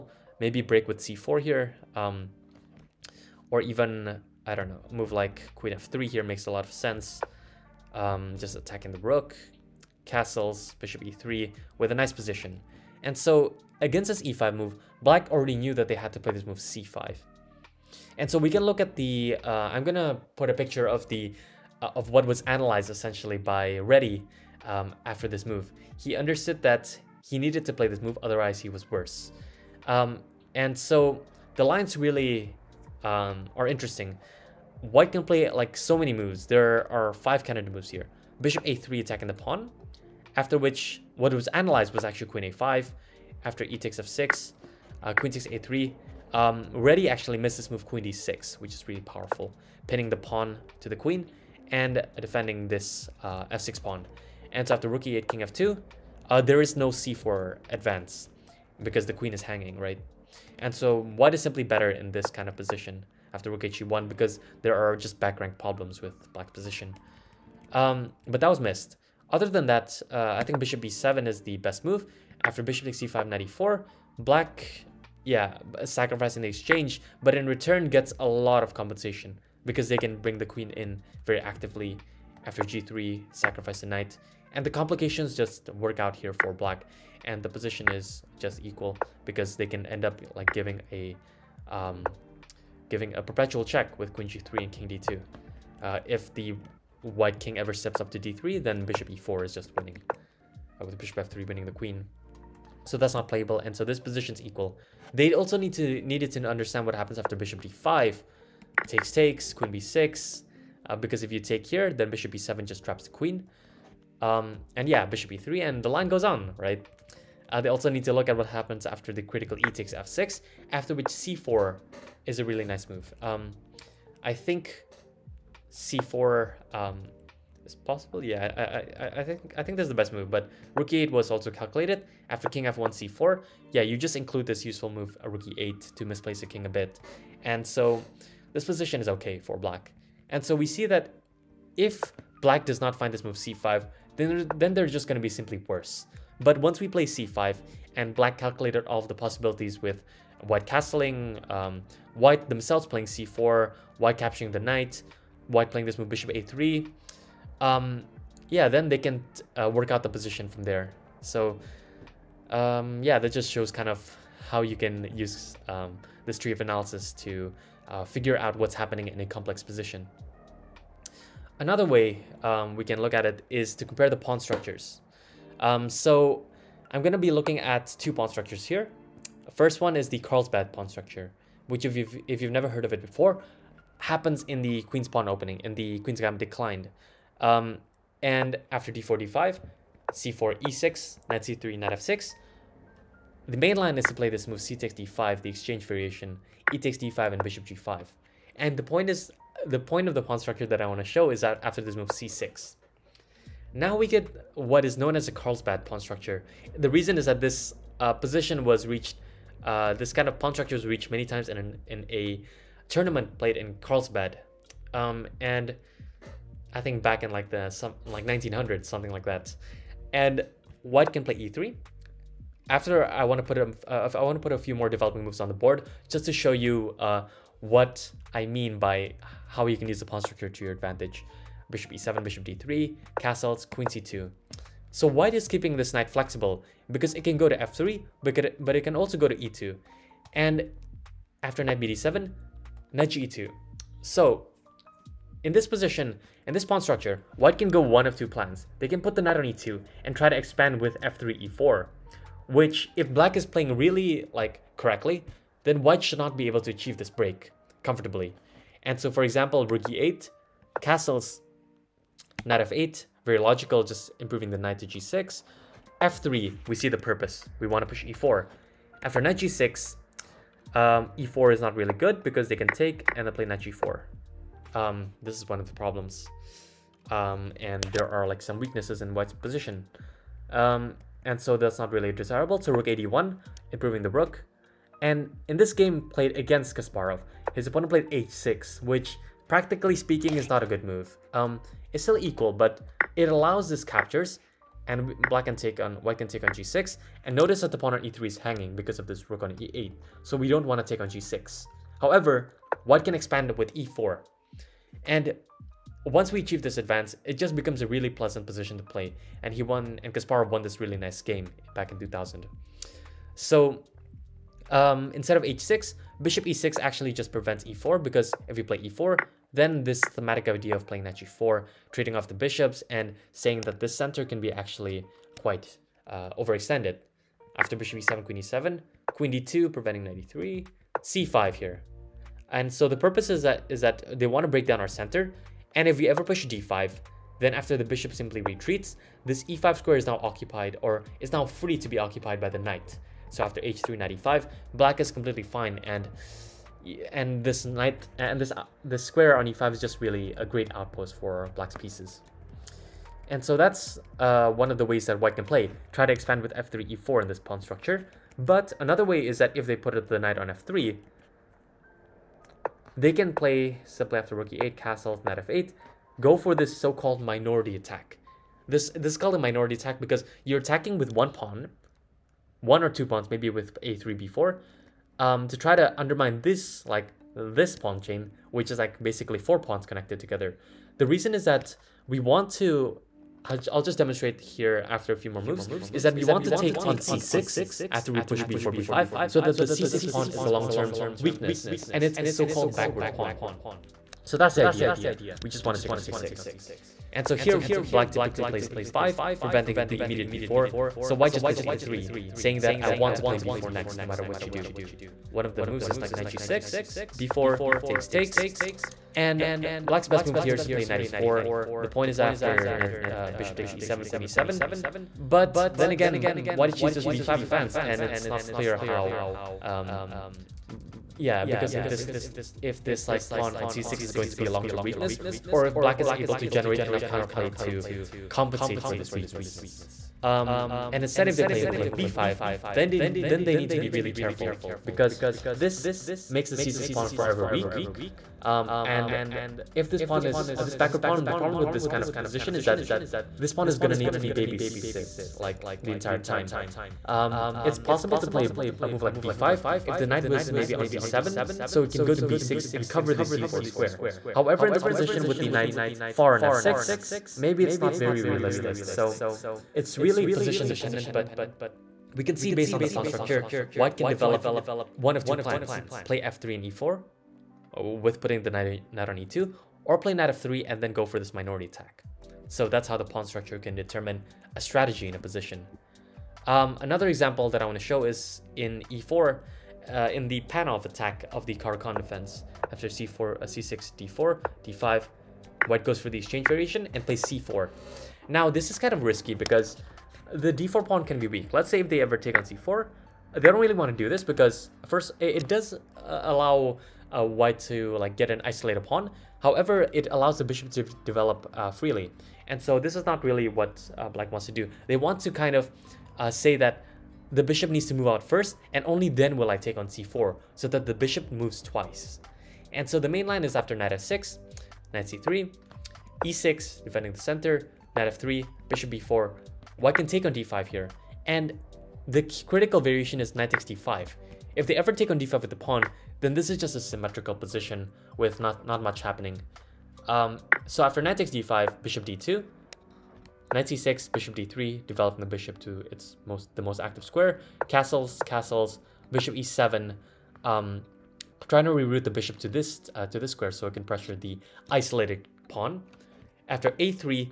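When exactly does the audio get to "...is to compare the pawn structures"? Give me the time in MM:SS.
02:53.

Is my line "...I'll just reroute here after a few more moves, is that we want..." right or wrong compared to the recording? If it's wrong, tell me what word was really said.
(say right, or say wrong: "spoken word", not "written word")
wrong: "demonstrate", not "reroute".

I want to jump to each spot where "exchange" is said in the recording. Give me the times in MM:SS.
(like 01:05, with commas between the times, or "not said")
01:16, 03:15, 08:06.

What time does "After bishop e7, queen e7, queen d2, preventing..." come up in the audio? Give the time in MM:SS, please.
05:27.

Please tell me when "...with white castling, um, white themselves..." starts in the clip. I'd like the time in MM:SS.
02:29.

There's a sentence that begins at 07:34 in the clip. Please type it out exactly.
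However, in this position with the knight far on f6, maybe it's not very realistic.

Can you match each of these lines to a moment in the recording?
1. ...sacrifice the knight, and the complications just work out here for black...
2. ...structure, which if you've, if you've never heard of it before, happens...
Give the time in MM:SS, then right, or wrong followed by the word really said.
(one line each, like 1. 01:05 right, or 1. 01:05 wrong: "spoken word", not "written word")
1. 01:23 right
2. 03:00 right.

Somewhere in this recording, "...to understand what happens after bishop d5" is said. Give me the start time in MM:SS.
01:46.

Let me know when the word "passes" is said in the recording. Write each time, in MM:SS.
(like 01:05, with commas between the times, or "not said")
not said.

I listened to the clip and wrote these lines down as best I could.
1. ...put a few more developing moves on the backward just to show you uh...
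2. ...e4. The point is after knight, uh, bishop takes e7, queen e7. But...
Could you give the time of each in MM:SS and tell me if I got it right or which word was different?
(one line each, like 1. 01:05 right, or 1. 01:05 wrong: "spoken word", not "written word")
1. 03:44 wrong: "board", not "backward"
2. 06:51 right.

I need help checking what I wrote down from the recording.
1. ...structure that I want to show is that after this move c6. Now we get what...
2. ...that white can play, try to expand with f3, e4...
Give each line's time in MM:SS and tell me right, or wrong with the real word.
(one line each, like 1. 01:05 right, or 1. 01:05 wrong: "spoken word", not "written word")
1. 03:20 right
2. 05:55 right.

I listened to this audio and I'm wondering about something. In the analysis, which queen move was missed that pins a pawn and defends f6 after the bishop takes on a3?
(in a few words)
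Queen d6.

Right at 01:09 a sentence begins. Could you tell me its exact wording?
Other than that, uh, I think bishop b7 is the best move.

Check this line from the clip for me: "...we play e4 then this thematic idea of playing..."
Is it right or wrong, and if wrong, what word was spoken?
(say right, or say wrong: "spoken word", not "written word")
right.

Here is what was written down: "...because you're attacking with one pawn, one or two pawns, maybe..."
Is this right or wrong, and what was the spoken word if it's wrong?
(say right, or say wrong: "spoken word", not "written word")
right.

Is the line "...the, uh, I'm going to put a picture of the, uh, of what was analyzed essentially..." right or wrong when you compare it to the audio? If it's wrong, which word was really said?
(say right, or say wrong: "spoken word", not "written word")
right.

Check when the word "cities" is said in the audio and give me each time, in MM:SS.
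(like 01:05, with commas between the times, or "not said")
not said.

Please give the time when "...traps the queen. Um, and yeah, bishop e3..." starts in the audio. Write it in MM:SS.
01:52.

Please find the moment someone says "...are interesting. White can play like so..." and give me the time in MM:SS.
00:33.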